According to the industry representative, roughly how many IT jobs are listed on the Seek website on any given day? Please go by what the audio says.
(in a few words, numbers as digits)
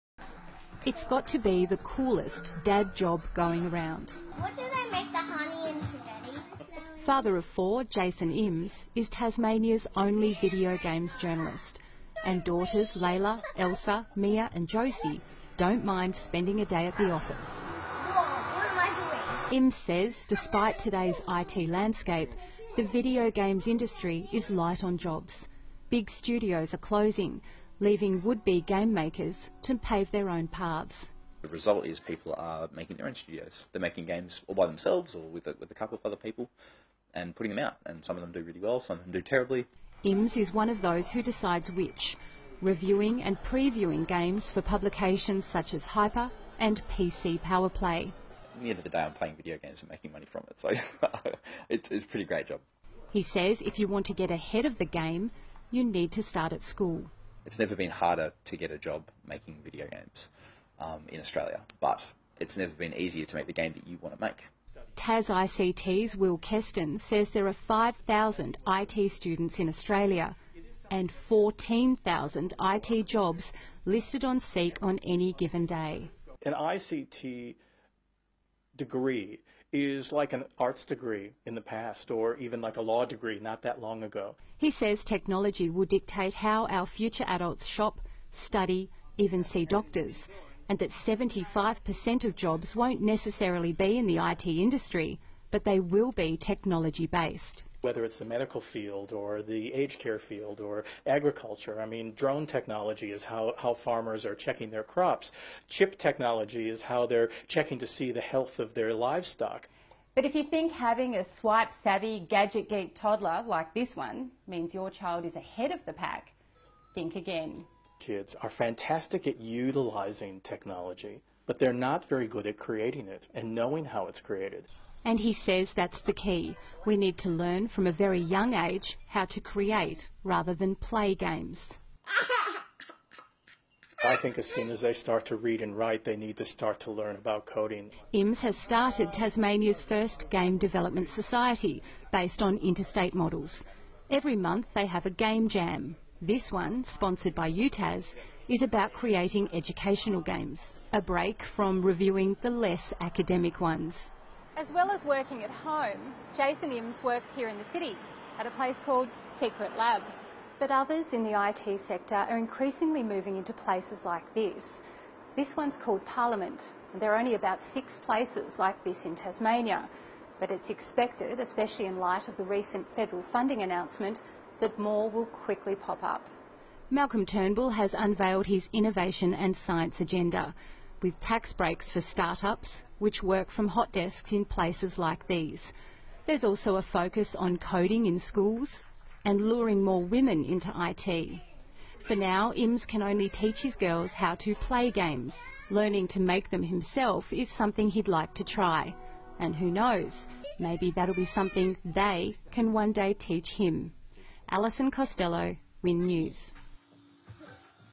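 14,000.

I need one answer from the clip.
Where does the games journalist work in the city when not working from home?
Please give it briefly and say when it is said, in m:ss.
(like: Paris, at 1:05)
Secret Lab, at 2:39.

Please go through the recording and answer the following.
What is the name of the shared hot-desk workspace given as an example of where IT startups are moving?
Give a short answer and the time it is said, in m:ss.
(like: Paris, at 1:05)
Parliament, at 2:46.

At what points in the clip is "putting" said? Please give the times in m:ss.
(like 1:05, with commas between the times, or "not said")
0:37.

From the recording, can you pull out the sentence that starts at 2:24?
Every month they have a game jam.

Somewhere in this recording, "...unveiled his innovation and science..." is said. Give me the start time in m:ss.
2:57.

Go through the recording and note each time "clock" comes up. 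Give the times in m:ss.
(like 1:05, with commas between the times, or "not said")
not said.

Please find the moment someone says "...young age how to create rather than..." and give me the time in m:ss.
2:08.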